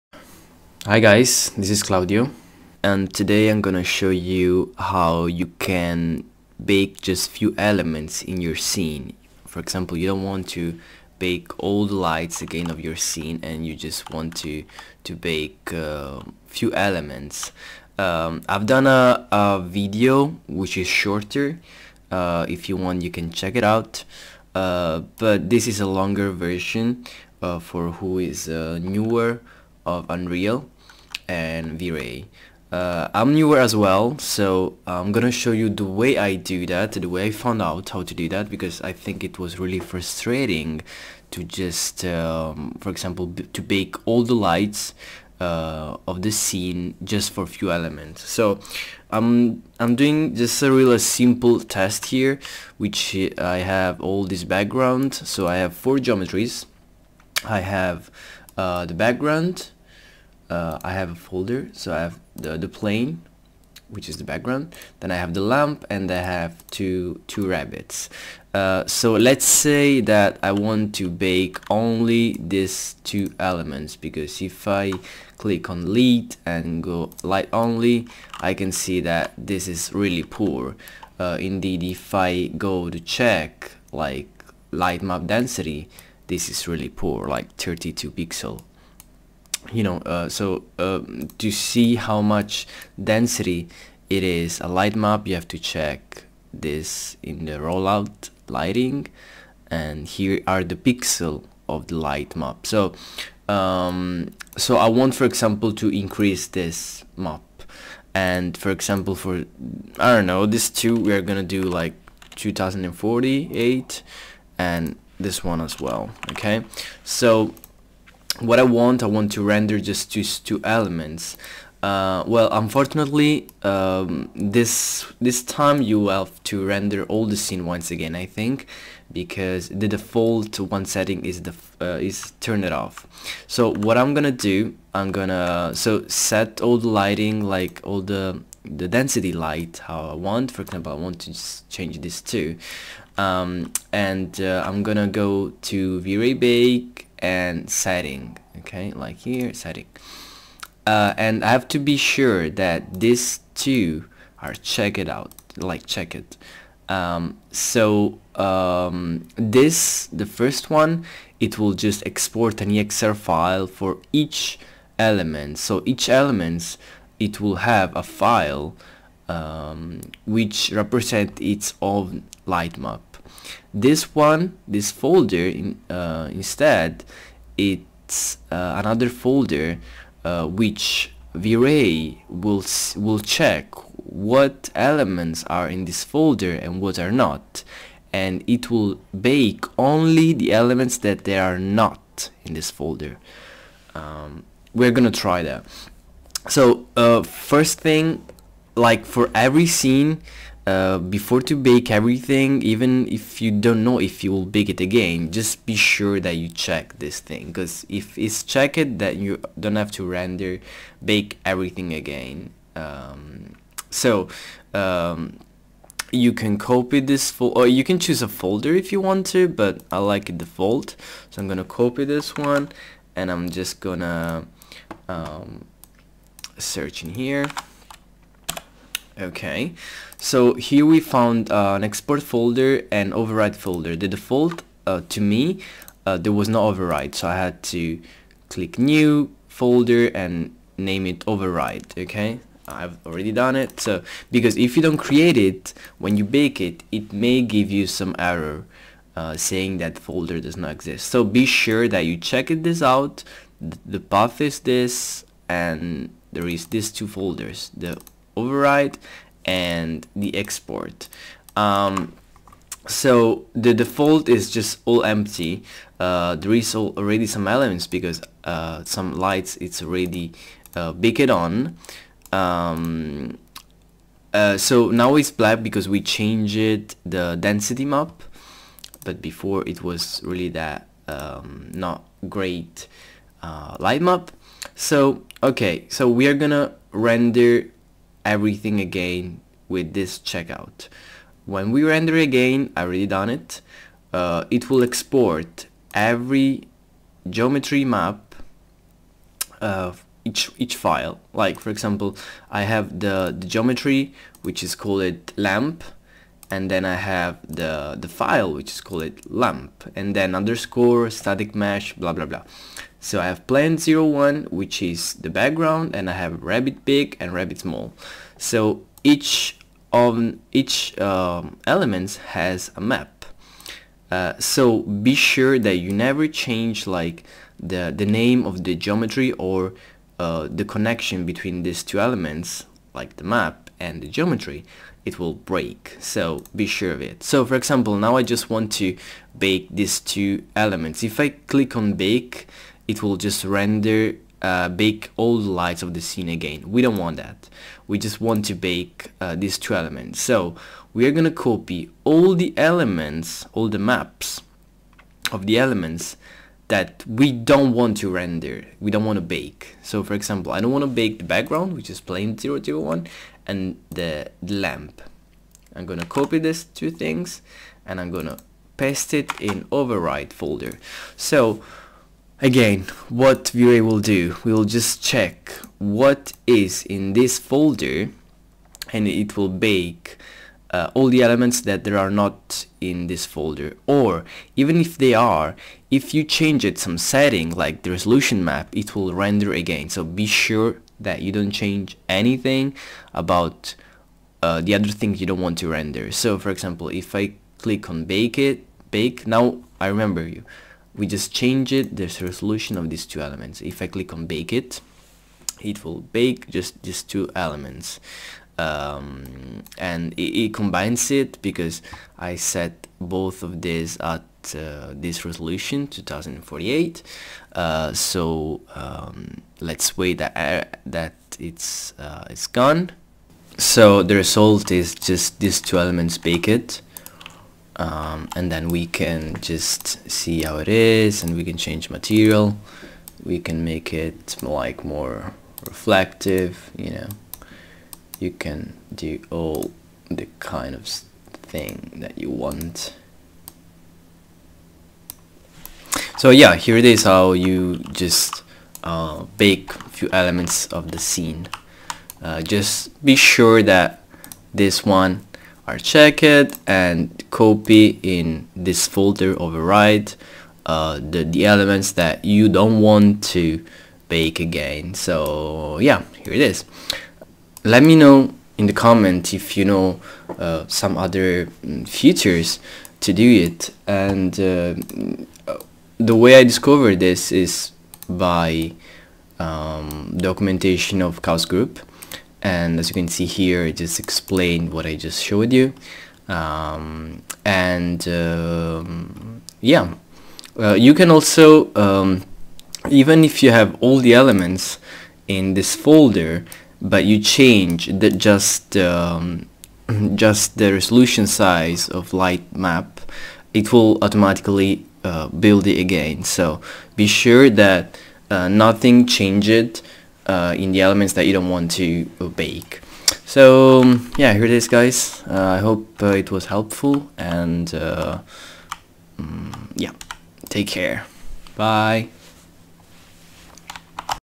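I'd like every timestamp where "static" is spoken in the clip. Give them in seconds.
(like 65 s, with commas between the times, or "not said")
311 s.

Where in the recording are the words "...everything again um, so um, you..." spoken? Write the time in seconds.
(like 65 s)
211 s.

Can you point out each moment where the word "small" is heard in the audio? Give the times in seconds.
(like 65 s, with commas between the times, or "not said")
317 s.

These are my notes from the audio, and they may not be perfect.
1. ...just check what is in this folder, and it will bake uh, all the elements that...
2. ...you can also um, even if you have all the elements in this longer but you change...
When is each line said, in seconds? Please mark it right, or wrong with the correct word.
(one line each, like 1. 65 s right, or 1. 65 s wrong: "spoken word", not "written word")
1. 374 s right
2. 490 s wrong: "folder", not "longer".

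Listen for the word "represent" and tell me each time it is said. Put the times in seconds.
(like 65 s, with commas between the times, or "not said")
170 s.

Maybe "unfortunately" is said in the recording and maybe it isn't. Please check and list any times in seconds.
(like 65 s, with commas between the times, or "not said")
122 s.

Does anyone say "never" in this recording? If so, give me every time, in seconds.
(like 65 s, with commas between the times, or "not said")
325 s.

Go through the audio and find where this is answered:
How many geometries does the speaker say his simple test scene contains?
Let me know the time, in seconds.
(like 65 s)
55 s.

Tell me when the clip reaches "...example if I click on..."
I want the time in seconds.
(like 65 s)
396 s.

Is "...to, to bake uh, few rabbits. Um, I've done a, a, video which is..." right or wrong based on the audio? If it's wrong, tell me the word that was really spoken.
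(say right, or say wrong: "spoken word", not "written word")
wrong: "elements", not "rabbits".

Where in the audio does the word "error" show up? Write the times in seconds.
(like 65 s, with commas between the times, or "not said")
248 s.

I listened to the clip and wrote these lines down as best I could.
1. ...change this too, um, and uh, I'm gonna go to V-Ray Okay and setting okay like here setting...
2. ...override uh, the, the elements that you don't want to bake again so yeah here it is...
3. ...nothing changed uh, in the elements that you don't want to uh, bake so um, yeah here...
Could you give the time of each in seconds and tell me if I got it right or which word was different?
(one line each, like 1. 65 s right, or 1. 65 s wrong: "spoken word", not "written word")
1. 141 s wrong: "Bake", not "Okay"
2. 459 s right
3. 508 s right.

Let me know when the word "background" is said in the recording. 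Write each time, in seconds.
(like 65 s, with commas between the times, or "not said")
54 s, 58 s, 64 s, 315 s, 361 s.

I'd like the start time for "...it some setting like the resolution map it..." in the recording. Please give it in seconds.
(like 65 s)
386 s.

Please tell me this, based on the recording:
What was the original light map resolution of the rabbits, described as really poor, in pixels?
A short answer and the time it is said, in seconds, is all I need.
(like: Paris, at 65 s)
32, at 87 s.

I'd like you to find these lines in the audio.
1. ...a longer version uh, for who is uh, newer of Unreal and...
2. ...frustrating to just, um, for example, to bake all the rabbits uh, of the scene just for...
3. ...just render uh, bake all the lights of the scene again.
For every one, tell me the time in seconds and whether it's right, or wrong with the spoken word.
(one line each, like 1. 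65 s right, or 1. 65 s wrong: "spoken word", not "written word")
1. 25 s right
2. 39 s wrong: "lights", not "rabbits"
3. 343 s right.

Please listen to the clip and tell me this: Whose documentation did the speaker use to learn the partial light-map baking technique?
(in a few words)
Chaos Group.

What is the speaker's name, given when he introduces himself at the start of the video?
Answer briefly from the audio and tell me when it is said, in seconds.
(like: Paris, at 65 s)
Claudio, at 1 s.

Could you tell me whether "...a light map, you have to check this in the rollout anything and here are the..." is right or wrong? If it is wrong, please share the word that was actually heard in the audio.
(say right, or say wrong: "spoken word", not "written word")
wrong: "lighting", not "anything".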